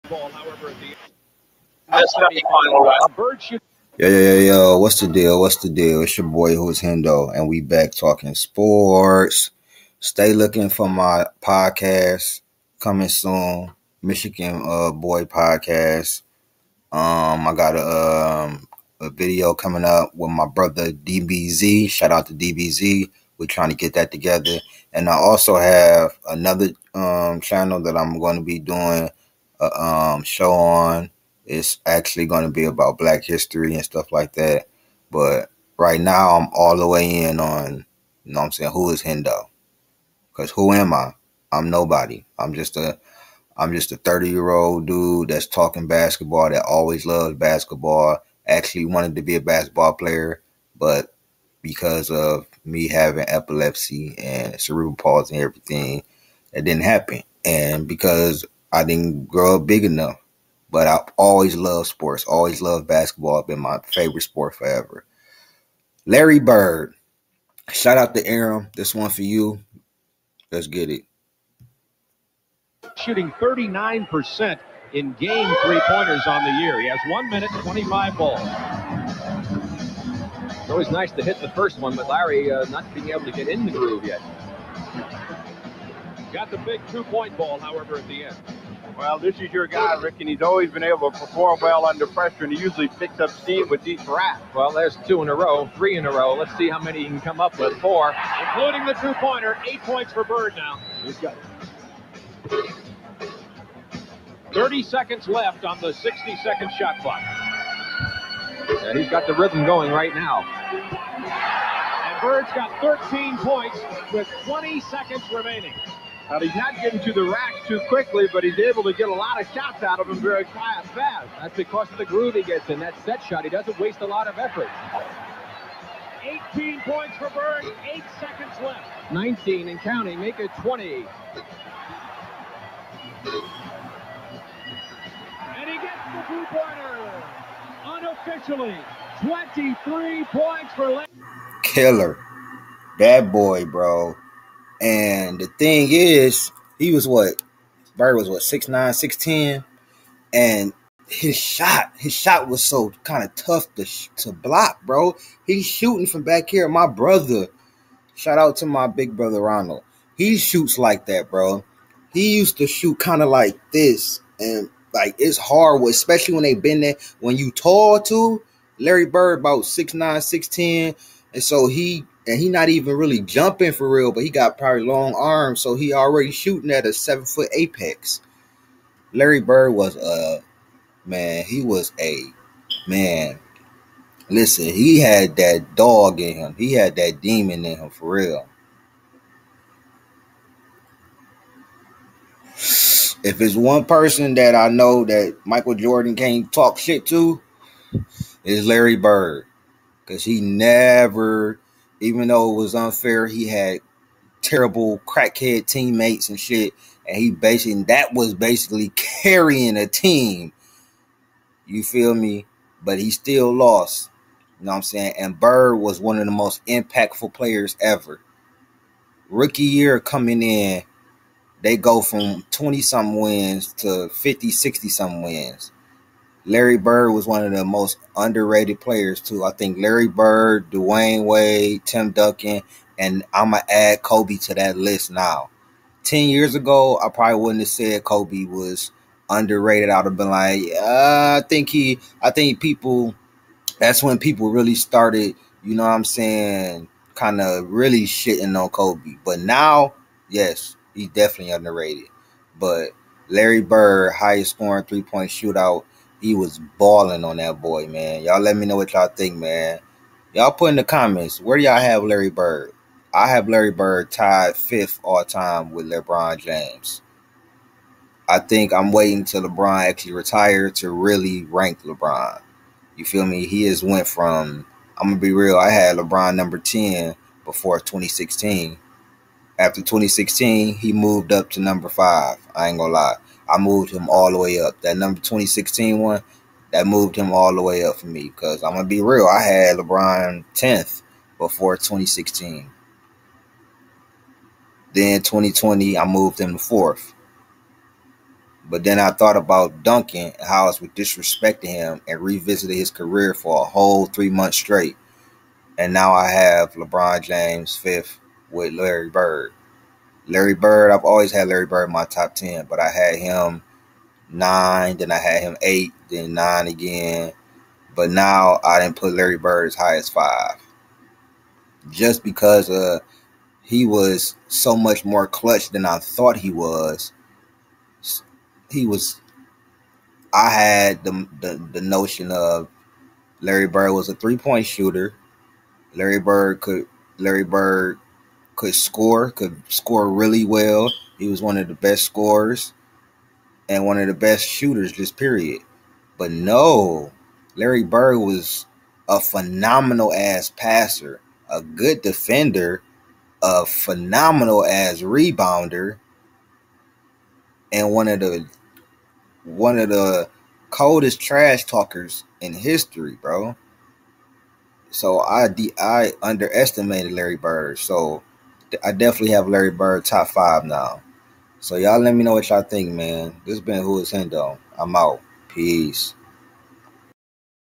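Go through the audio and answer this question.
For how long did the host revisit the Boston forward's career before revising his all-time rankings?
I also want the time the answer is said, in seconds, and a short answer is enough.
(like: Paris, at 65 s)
three months, at 304 s.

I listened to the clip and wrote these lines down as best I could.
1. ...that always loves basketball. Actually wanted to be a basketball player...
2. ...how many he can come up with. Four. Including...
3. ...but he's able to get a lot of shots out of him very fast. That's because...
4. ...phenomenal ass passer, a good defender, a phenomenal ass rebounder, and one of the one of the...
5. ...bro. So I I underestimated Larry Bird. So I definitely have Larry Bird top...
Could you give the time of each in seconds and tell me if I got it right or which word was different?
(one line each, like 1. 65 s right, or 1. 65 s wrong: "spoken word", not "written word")
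1. 46 s right
2. 96 s right
3. 118 s right
4. 349 s right
5. 363 s right.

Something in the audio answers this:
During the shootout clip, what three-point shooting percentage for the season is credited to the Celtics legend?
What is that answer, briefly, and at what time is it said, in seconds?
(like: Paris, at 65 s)
39%, at 73 s.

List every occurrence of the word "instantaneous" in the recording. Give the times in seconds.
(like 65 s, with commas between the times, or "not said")
not said.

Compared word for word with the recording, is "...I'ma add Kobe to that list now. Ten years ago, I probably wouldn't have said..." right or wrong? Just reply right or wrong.
right.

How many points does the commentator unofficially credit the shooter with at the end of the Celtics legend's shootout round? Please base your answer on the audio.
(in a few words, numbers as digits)
23.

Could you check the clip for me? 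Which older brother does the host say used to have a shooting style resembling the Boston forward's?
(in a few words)
Ronald.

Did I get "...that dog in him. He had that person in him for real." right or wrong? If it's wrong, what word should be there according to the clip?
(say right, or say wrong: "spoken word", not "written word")
wrong: "demon", not "person".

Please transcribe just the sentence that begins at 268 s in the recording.
I think I'm waiting till LeBron actually retire to really rank LeBron.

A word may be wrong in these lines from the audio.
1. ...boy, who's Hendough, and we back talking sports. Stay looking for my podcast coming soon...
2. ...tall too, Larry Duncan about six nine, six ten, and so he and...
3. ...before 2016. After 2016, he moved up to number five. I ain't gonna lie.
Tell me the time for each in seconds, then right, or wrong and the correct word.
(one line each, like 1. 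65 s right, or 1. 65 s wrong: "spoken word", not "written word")
1. 6 s right
2. 167 s wrong: "Bird", not "Duncan"
3. 277 s right.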